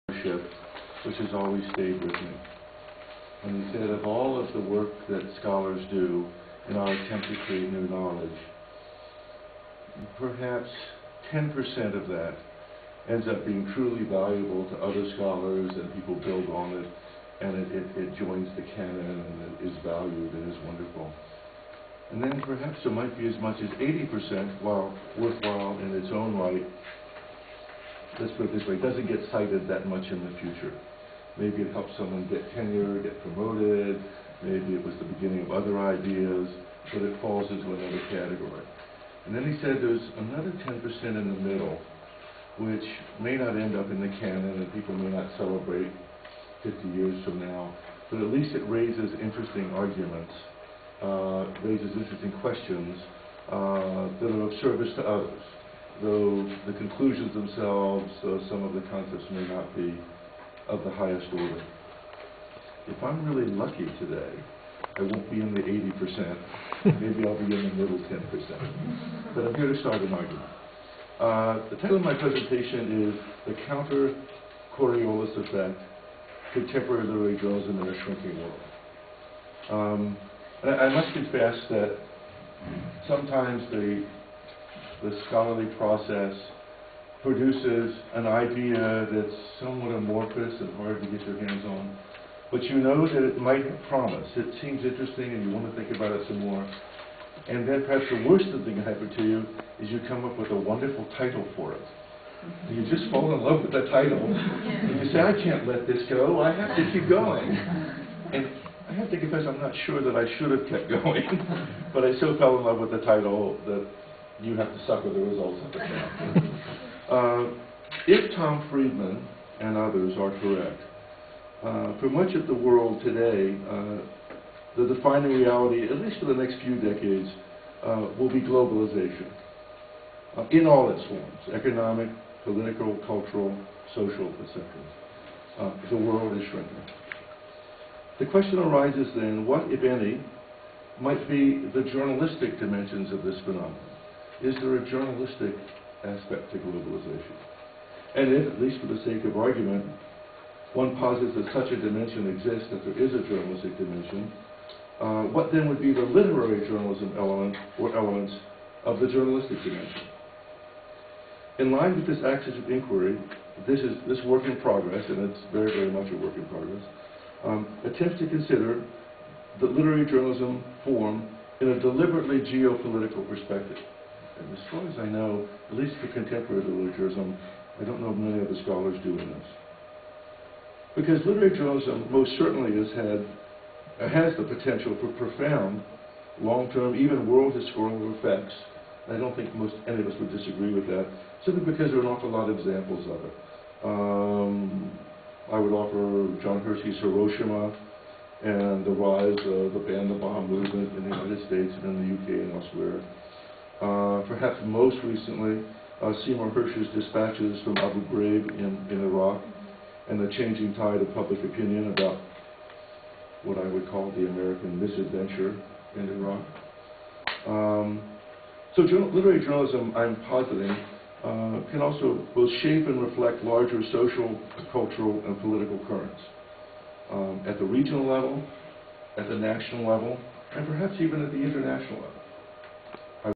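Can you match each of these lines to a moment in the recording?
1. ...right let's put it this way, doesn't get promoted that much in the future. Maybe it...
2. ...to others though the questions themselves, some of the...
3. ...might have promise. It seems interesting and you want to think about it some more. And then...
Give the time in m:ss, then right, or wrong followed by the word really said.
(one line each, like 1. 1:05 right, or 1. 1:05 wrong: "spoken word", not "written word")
1. 0:26 wrong: "cited", not "promoted"
2. 0:54 wrong: "conclusions", not "questions"
3. 1:33 right.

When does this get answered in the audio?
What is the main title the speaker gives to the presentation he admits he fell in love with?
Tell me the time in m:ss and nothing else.
1:13.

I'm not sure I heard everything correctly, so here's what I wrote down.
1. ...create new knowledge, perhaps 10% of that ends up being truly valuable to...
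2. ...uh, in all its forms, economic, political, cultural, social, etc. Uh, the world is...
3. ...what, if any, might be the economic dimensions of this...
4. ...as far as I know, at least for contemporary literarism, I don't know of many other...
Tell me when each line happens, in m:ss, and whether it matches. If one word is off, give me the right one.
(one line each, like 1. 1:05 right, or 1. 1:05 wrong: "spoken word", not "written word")
1. 0:07 right
2. 2:10 right
3. 2:19 wrong: "journalistic", not "economic"
4. 2:54 right.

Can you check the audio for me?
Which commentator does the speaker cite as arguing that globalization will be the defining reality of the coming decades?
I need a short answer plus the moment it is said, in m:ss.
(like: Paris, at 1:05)
Tom Friedman, at 1:58.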